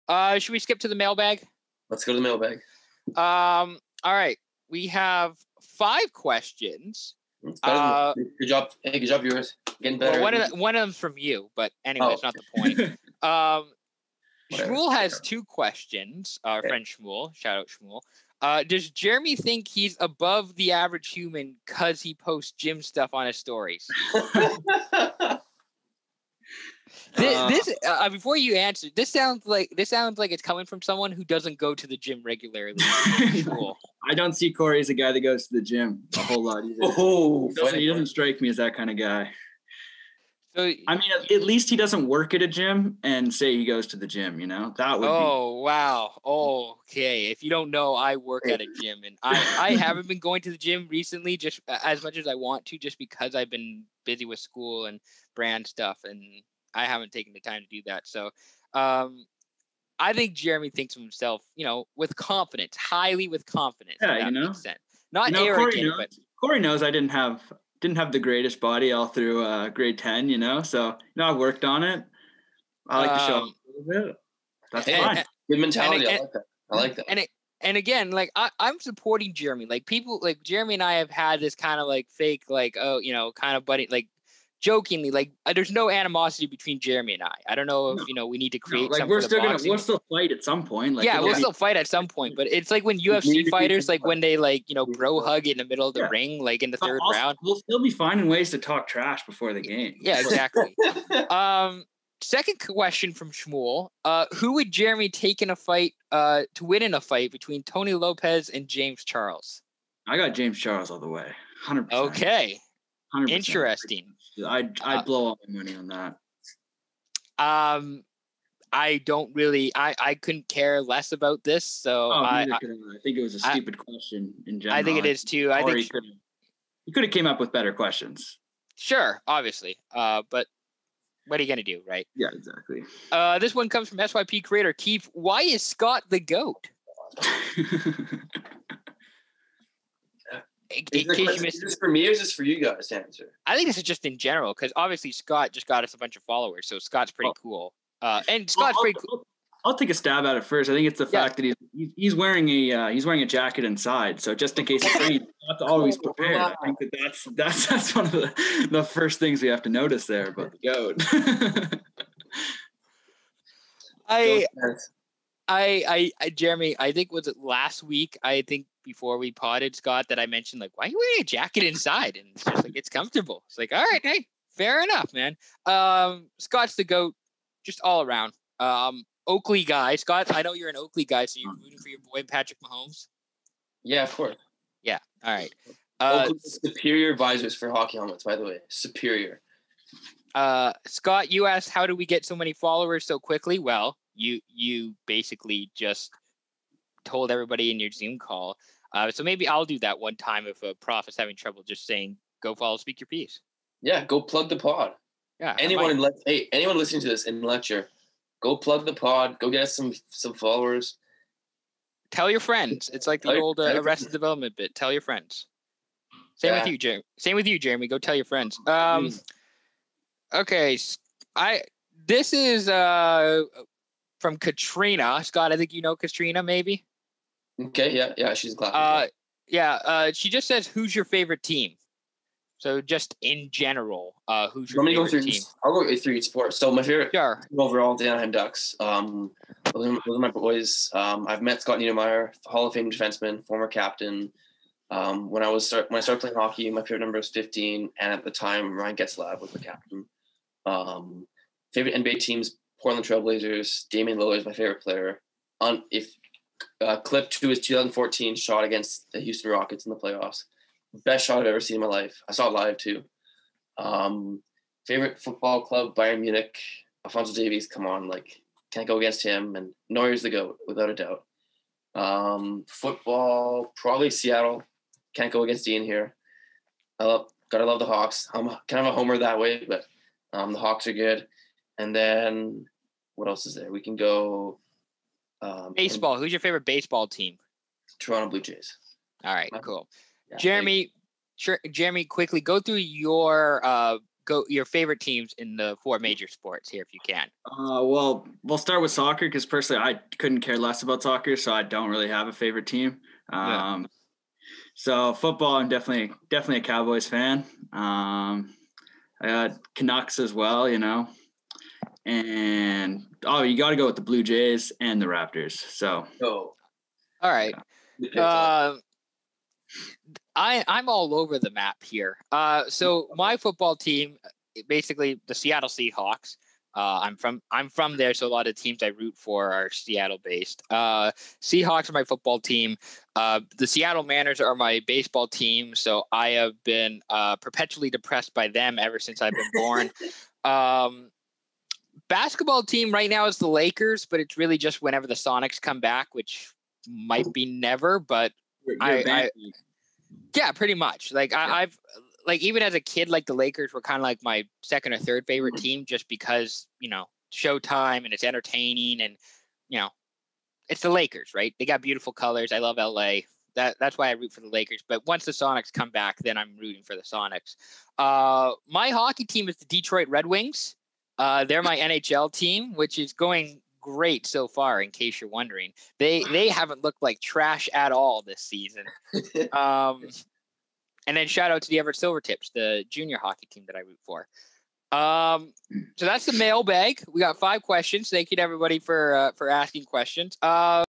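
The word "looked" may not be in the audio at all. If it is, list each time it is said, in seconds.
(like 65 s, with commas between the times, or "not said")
376 s.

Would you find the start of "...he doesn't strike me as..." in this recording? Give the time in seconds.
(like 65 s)
37 s.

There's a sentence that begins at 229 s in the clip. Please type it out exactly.
Uh, she just says, "Who's your favorite team?" So just in general, uh, who's your favorite through, team?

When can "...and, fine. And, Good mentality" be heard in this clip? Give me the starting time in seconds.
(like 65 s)
74 s.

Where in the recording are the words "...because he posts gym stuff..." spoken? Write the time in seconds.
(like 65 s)
21 s.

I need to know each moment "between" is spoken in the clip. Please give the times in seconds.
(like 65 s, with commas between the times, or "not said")
86 s, 107 s.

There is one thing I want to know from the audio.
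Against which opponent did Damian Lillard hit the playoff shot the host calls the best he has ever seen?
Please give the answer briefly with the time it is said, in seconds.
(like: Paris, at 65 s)
Houston Rockets, at 257 s.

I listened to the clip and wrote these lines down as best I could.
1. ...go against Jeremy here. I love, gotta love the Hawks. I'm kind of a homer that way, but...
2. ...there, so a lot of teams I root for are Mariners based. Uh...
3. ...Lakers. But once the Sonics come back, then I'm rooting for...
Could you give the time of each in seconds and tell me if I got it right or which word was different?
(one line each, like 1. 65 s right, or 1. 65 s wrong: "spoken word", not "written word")
1. 275 s wrong: "Ian", not "Jeremy"
2. 327 s wrong: "Seattle", not "Mariners"
3. 364 s right.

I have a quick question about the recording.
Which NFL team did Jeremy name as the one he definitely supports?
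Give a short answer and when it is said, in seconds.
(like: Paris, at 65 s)
Cowboys, at 305 s.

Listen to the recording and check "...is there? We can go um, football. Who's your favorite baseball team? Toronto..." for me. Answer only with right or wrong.
wrong.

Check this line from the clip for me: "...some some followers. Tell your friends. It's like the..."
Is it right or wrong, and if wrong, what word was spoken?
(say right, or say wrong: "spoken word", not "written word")
right.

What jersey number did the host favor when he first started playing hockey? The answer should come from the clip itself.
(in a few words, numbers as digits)
15.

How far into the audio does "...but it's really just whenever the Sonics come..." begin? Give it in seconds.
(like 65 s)
344 s.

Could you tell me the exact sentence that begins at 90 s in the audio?
Like, yeah, we'll still fight at some point.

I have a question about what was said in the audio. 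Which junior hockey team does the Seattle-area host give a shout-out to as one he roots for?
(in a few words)
Everett Silvertips.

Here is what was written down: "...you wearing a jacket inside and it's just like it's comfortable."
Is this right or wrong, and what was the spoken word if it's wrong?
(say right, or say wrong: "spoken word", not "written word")
right.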